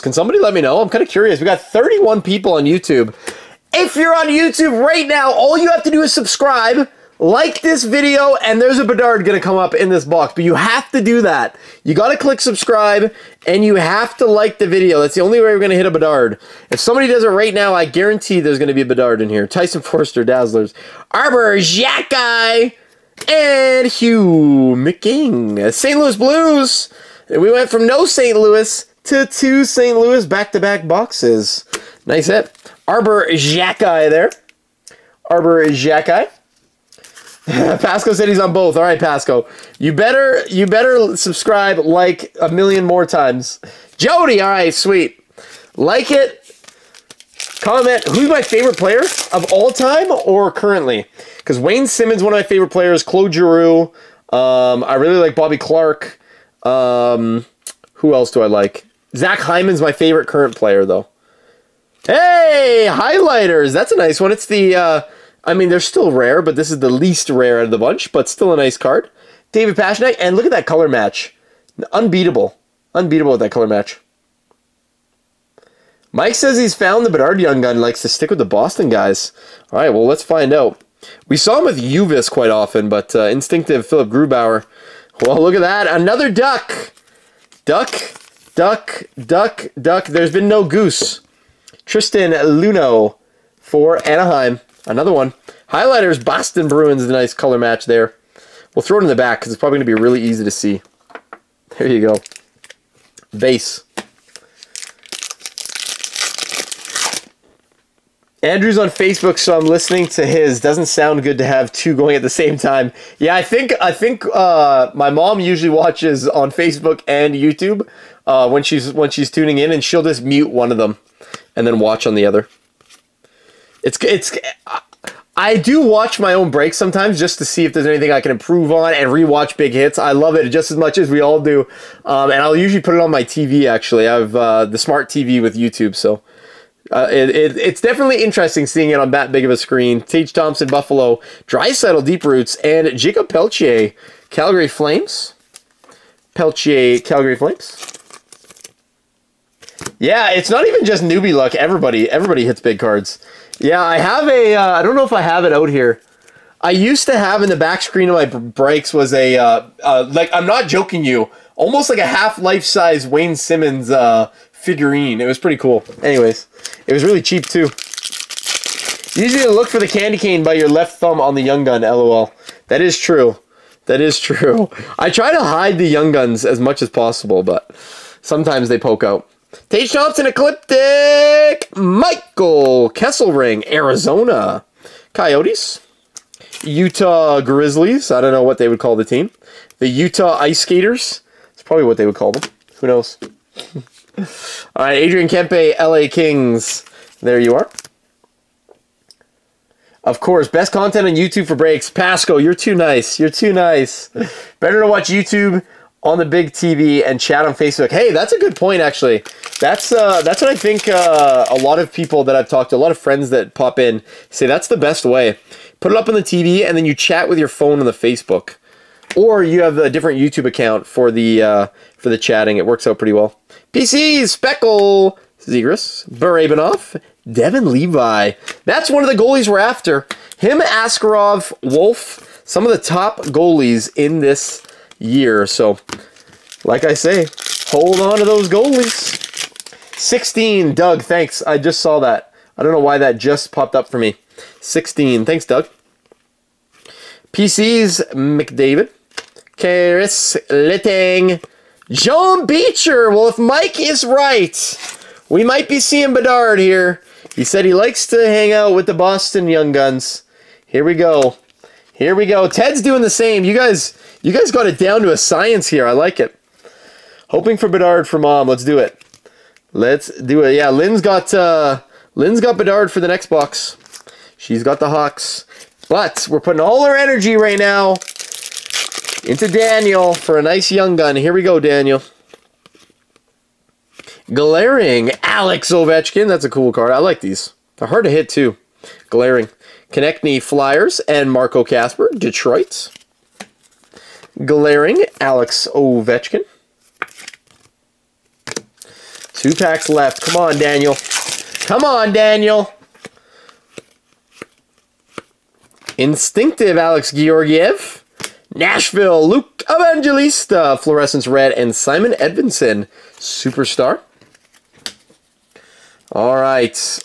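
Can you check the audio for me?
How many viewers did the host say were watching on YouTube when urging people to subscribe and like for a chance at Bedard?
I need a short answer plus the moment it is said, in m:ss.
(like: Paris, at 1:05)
31, at 0:01.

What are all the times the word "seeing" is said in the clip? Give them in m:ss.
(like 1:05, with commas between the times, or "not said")
2:18, 4:15.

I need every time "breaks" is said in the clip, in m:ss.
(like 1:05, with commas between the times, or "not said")
2:06, 3:21.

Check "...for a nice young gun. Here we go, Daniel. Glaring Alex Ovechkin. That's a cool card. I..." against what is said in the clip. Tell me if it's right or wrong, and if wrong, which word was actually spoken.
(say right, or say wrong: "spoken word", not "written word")
right.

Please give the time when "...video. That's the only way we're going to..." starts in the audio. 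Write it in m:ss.
0:14.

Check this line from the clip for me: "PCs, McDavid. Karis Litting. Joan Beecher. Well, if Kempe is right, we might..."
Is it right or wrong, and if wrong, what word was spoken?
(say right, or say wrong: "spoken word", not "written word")
wrong: "Mike", not "Kempe".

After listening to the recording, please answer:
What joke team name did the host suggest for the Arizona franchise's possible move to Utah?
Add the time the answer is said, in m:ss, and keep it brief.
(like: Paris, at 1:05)
Utah Ice Skaters, at 3:09.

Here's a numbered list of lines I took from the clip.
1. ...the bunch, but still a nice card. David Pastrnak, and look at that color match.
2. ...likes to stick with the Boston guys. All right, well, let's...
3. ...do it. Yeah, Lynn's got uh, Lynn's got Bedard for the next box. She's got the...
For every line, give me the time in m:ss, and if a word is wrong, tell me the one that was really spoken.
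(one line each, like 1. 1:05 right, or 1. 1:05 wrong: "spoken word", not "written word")
1. 1:07 right
2. 1:17 right
3. 4:30 right.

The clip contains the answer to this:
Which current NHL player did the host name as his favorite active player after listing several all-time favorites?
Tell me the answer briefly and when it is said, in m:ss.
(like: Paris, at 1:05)
Zach Hyman, at 0:59.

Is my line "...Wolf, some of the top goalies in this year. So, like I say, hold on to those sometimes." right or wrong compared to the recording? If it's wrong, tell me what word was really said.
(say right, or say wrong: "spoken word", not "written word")
wrong: "goalies", not "sometimes".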